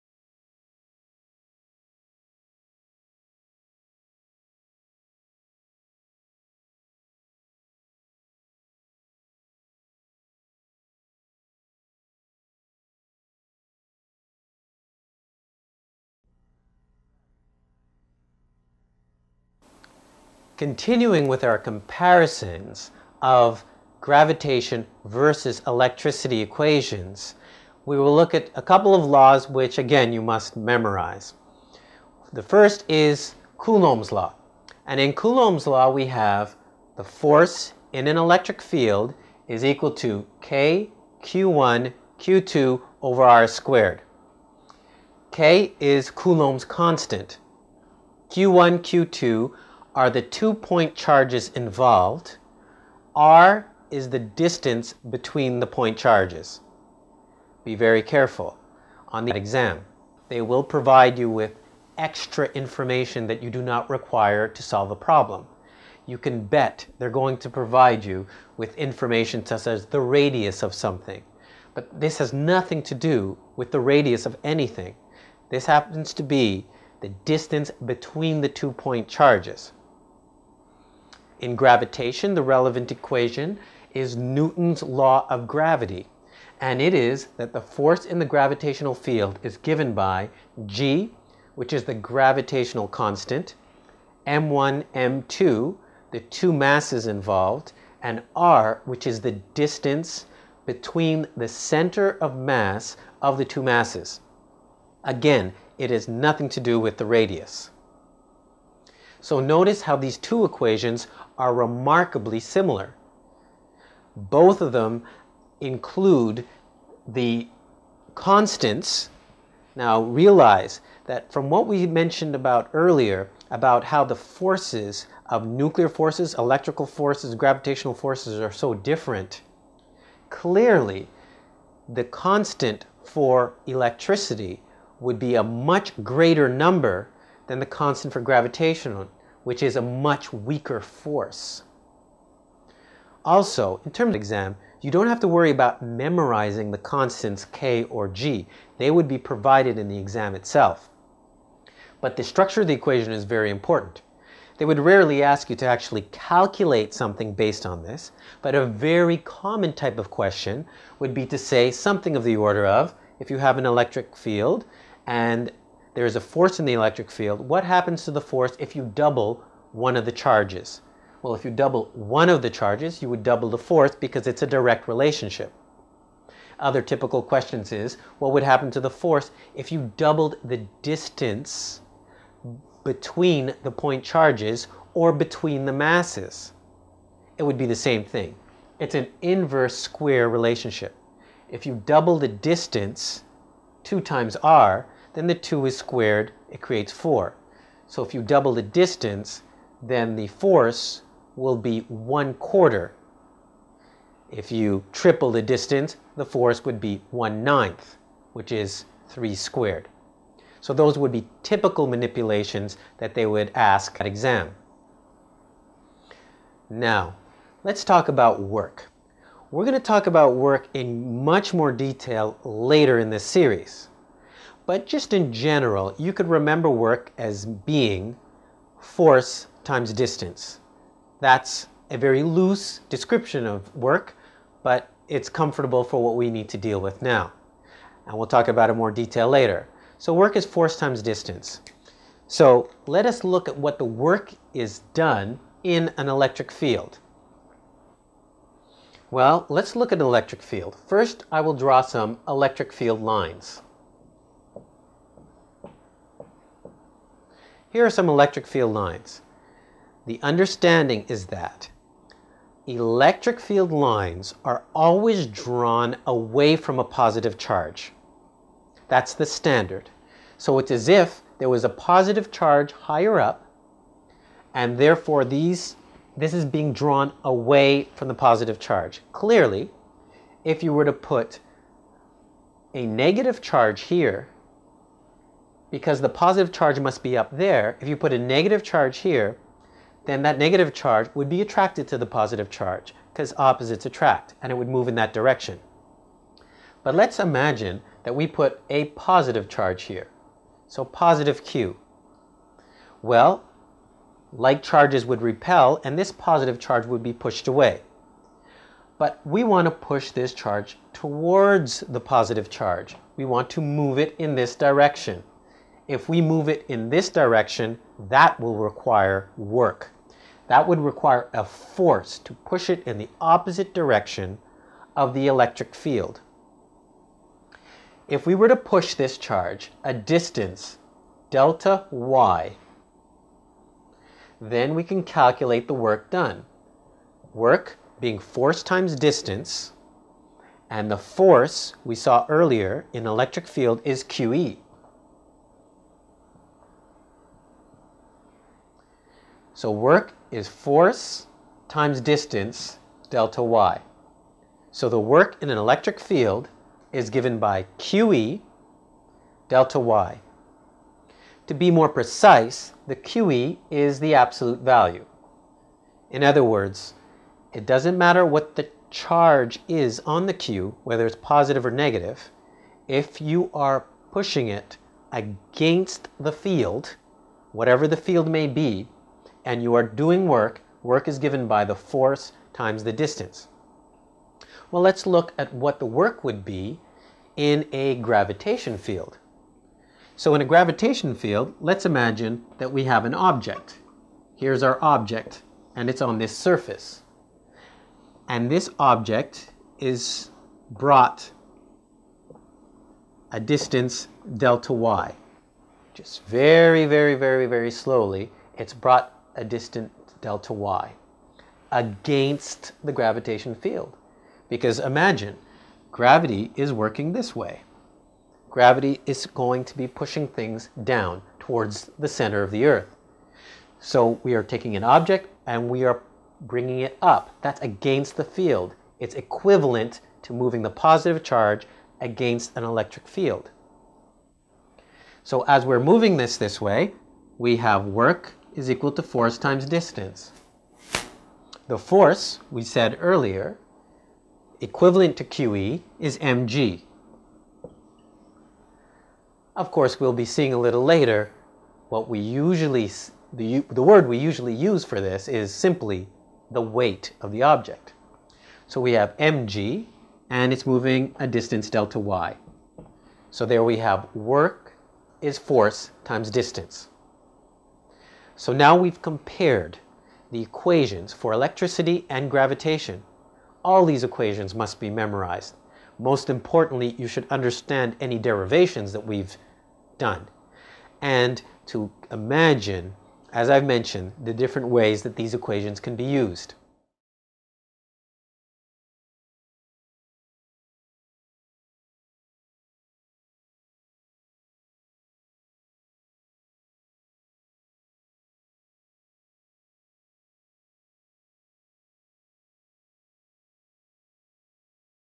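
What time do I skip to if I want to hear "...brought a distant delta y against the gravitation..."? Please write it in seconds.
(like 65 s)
408 s.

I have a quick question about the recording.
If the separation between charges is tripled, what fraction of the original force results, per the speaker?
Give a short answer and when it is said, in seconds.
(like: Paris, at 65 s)
1/9, at 207 s.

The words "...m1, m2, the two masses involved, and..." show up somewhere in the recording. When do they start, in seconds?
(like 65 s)
94 s.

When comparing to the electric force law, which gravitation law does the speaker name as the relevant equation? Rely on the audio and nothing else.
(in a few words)
Newton's law of gravity.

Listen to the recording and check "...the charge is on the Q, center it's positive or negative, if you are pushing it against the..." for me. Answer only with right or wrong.
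wrong.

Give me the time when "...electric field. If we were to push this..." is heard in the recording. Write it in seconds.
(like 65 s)
325 s.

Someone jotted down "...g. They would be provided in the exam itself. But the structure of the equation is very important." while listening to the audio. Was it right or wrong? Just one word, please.
right.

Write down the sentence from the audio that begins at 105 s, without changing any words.
Again, it has nothing to do with the radius.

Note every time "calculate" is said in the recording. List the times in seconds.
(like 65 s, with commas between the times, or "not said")
156 s, 335 s.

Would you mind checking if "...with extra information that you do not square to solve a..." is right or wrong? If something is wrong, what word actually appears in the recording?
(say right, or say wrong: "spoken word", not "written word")
wrong: "require", not "square".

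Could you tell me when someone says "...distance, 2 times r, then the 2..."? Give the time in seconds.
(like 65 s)
192 s.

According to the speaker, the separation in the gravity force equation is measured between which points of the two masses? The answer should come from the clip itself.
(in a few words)
center of mass.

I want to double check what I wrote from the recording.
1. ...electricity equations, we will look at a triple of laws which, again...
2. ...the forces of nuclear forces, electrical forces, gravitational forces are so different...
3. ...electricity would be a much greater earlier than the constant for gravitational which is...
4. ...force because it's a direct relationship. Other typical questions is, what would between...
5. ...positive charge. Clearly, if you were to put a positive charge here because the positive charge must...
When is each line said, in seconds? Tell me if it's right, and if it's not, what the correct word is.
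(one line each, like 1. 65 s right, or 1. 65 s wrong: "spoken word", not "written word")
1. 25 s wrong: "couple", not "triple"
2. 124 s right
3. 133 s wrong: "number", not "earlier"
4. 173 s wrong: "happen", not "between"
5. 278 s wrong: "negative", not "positive".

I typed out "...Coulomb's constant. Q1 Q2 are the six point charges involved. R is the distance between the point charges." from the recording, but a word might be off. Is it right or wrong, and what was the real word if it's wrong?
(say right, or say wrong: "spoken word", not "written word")
wrong: "two", not "six".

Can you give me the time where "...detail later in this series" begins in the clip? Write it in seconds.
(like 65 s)
221 s.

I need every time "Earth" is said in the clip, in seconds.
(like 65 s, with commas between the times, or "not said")
422 s.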